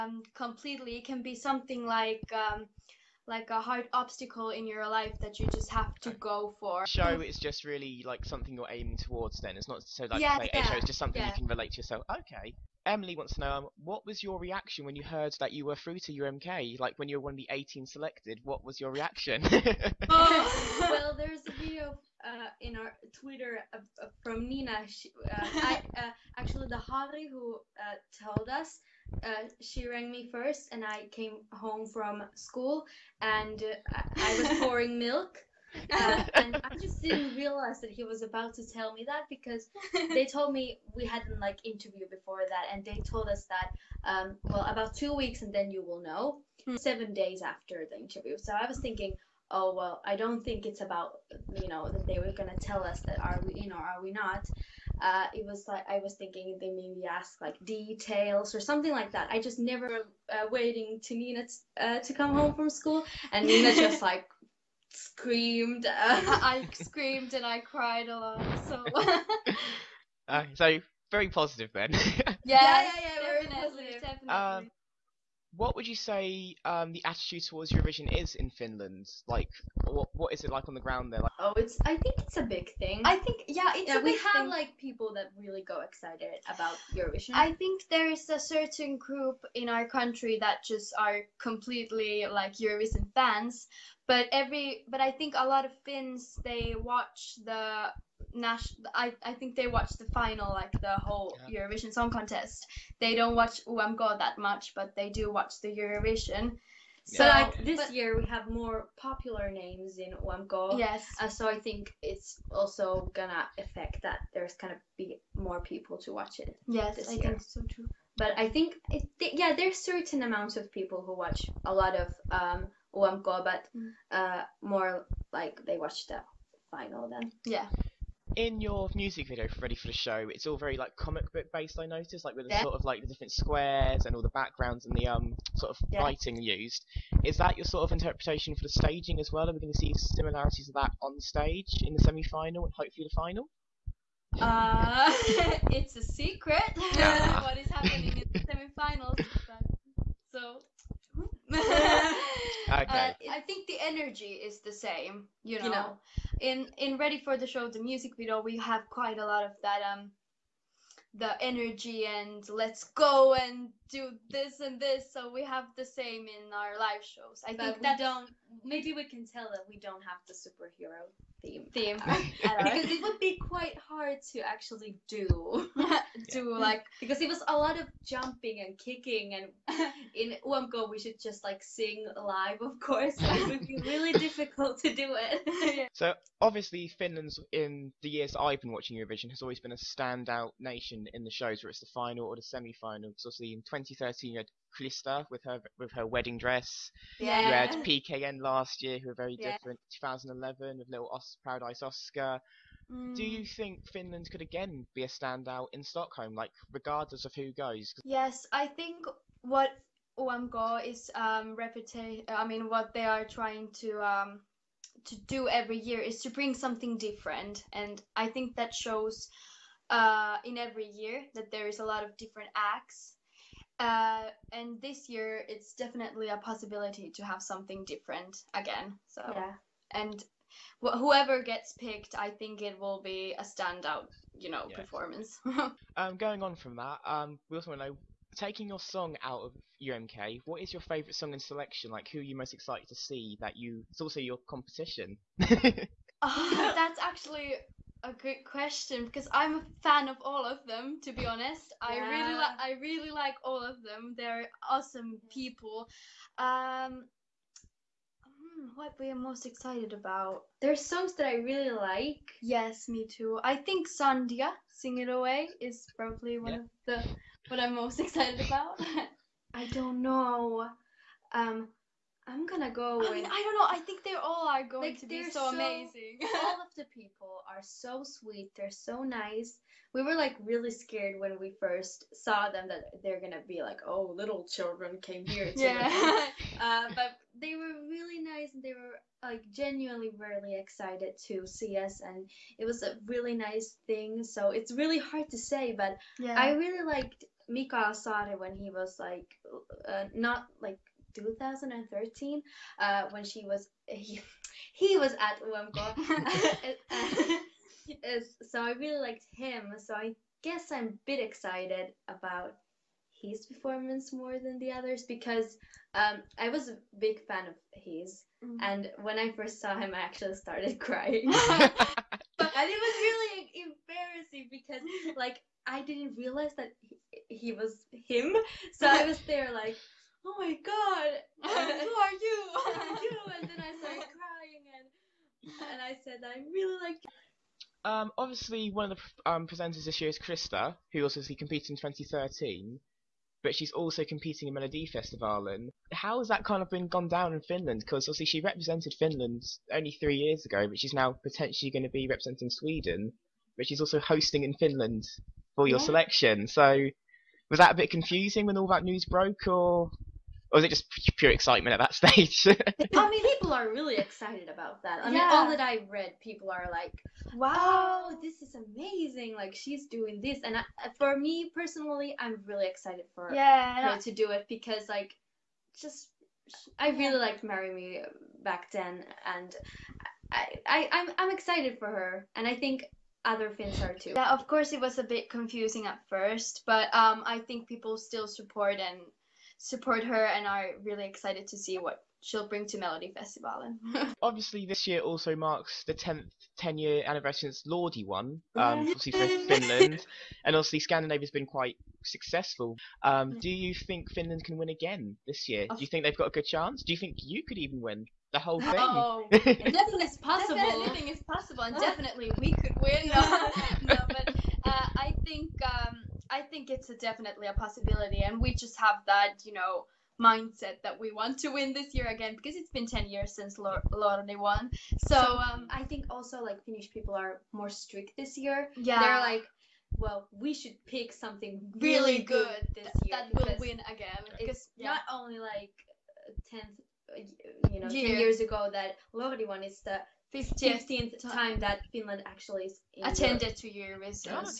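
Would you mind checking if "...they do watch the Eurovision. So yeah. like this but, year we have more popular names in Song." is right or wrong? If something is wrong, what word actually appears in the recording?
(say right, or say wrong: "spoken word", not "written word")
wrong: "UMK", not "Song".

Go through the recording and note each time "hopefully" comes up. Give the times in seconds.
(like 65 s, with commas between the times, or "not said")
142 s.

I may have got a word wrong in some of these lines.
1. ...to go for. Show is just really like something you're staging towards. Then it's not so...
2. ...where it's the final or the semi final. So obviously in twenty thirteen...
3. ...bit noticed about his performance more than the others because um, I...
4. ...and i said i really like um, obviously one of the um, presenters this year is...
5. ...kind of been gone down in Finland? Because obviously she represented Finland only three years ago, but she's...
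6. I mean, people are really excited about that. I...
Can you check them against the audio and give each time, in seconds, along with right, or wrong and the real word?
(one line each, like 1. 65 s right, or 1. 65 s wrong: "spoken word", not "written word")
1. 5 s wrong: "aiming", not "staging"
2. 191 s right
3. 311 s wrong: "excited", not "noticed"
4. 335 s right
5. 346 s right
6. 362 s right.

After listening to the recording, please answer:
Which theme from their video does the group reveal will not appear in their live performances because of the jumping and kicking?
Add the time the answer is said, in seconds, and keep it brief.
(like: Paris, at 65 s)
Superhero theme, at 170 s.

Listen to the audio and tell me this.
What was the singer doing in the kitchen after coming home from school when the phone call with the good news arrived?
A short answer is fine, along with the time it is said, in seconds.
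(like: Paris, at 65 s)
Pouring milk, at 34 s.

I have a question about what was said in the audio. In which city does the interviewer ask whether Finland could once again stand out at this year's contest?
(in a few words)
Stockholm.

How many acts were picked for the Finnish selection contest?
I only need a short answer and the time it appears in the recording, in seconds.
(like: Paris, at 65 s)
18, at 17 s.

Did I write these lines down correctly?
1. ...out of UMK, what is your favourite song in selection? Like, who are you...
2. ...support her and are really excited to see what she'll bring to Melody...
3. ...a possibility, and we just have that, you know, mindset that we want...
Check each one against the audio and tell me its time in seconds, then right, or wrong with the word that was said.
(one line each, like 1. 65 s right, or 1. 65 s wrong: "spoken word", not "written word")
1. 239 s right
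2. 389 s right
3. 417 s right.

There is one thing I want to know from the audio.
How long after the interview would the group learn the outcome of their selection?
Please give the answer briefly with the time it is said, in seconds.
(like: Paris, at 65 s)
Seven days, at 46 s.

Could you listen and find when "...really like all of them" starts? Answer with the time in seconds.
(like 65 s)
252 s.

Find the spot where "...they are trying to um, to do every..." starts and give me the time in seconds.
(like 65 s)
212 s.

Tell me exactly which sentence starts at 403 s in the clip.
Um, do you think Finland can win again this year?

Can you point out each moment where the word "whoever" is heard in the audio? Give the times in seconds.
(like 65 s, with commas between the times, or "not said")
230 s.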